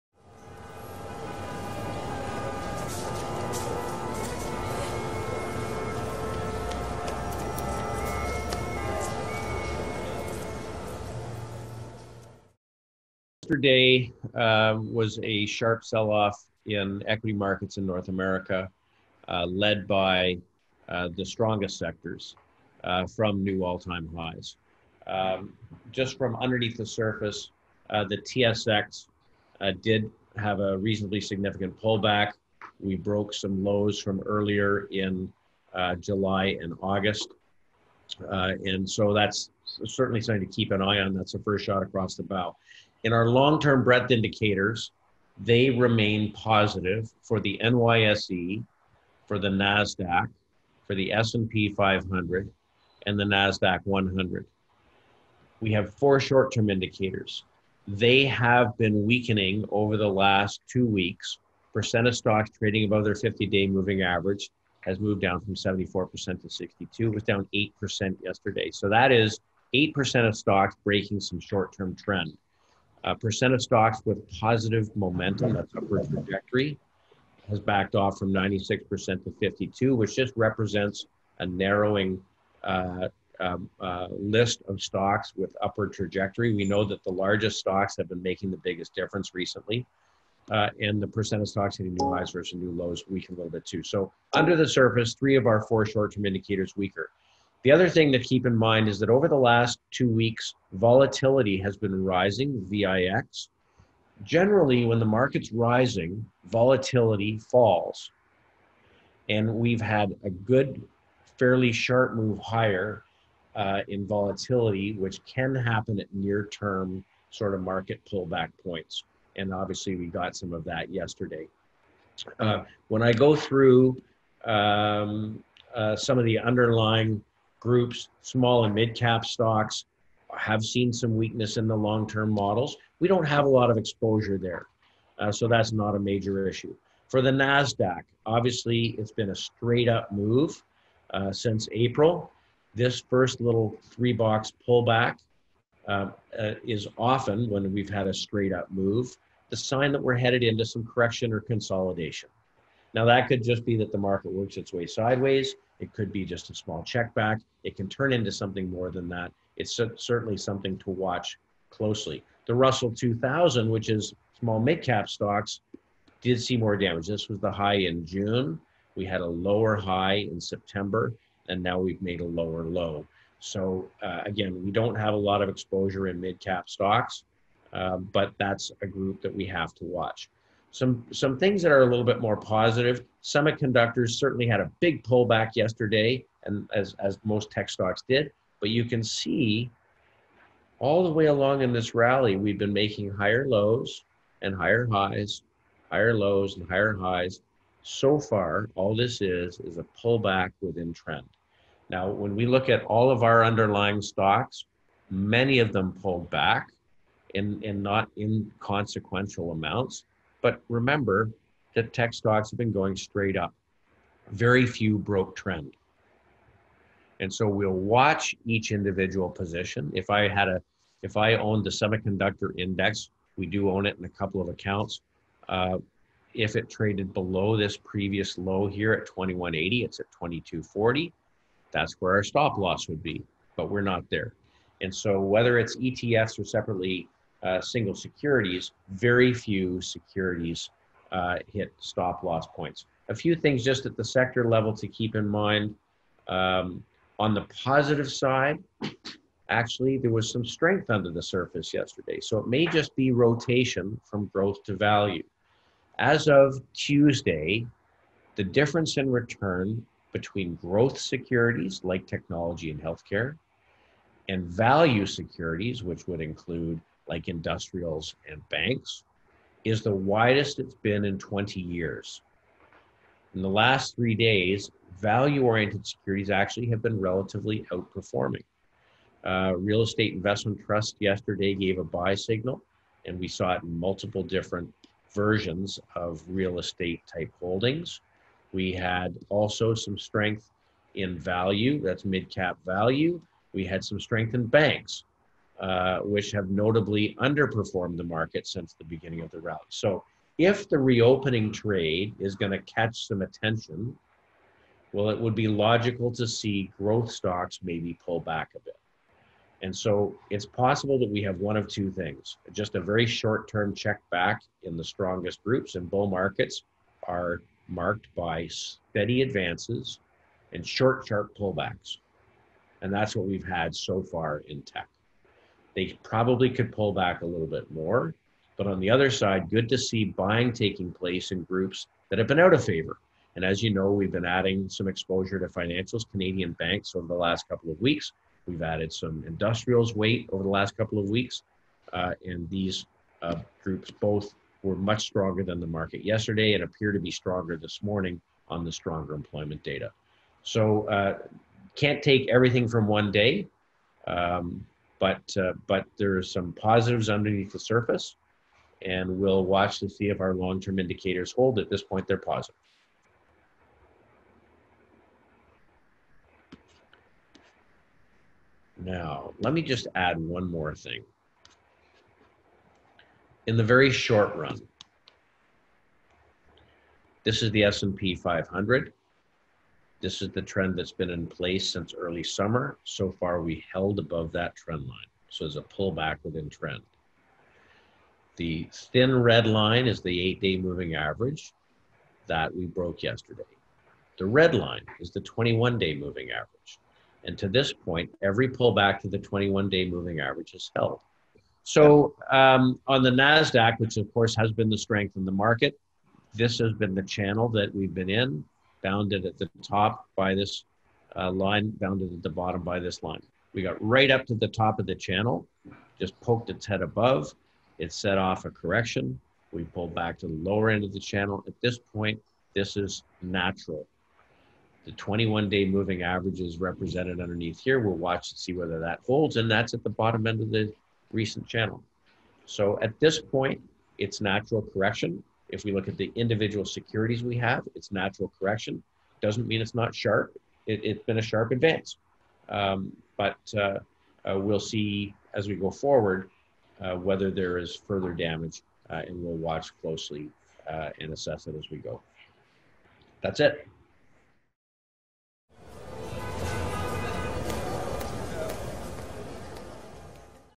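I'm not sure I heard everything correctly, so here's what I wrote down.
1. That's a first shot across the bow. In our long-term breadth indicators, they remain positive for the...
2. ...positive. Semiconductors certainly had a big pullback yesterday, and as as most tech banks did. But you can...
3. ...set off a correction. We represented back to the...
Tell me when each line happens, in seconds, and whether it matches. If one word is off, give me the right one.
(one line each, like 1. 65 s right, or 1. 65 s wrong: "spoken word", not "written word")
1. 41 s right
2. 182 s wrong: "stocks", not "banks"
3. 417 s wrong: "pulled", not "represented".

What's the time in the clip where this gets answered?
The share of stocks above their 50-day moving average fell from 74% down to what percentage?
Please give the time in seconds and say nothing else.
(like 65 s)
66 s.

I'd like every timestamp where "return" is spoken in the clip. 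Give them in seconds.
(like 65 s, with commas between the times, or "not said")
259 s.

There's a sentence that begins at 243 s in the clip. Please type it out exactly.
A few things just at the sector level to keep in mind.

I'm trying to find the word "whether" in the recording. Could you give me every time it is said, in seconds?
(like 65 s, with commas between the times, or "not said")
235 s, 428 s, 446 s.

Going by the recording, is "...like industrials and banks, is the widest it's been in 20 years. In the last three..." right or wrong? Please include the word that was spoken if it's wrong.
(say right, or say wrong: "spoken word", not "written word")
right.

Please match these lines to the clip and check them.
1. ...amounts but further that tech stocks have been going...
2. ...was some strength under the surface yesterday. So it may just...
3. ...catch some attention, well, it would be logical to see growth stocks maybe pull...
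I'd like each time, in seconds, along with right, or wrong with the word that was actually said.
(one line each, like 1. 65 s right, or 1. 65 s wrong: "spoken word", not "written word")
1. 209 s wrong: "remember", not "further"
2. 250 s right
3. 302 s right.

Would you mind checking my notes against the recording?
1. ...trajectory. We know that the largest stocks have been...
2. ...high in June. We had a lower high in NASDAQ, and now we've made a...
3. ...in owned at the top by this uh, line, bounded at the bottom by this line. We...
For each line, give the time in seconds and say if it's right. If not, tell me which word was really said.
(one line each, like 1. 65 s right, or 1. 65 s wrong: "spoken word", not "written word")
1. 85 s right
2. 167 s wrong: "September", not "NASDAQ"
3. 408 s wrong: "bounded", not "owned".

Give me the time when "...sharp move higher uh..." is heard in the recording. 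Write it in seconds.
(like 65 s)
111 s.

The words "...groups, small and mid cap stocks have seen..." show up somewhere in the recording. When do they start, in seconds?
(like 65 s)
127 s.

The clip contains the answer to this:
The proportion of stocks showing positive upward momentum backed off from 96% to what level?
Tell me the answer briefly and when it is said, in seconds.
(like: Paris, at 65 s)
52%, at 79 s.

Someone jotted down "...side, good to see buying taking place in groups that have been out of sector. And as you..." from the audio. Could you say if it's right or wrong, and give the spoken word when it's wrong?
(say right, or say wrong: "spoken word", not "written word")
wrong: "favor", not "sector".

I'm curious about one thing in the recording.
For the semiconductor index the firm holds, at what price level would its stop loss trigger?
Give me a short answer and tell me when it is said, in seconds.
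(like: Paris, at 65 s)
2180, at 229 s.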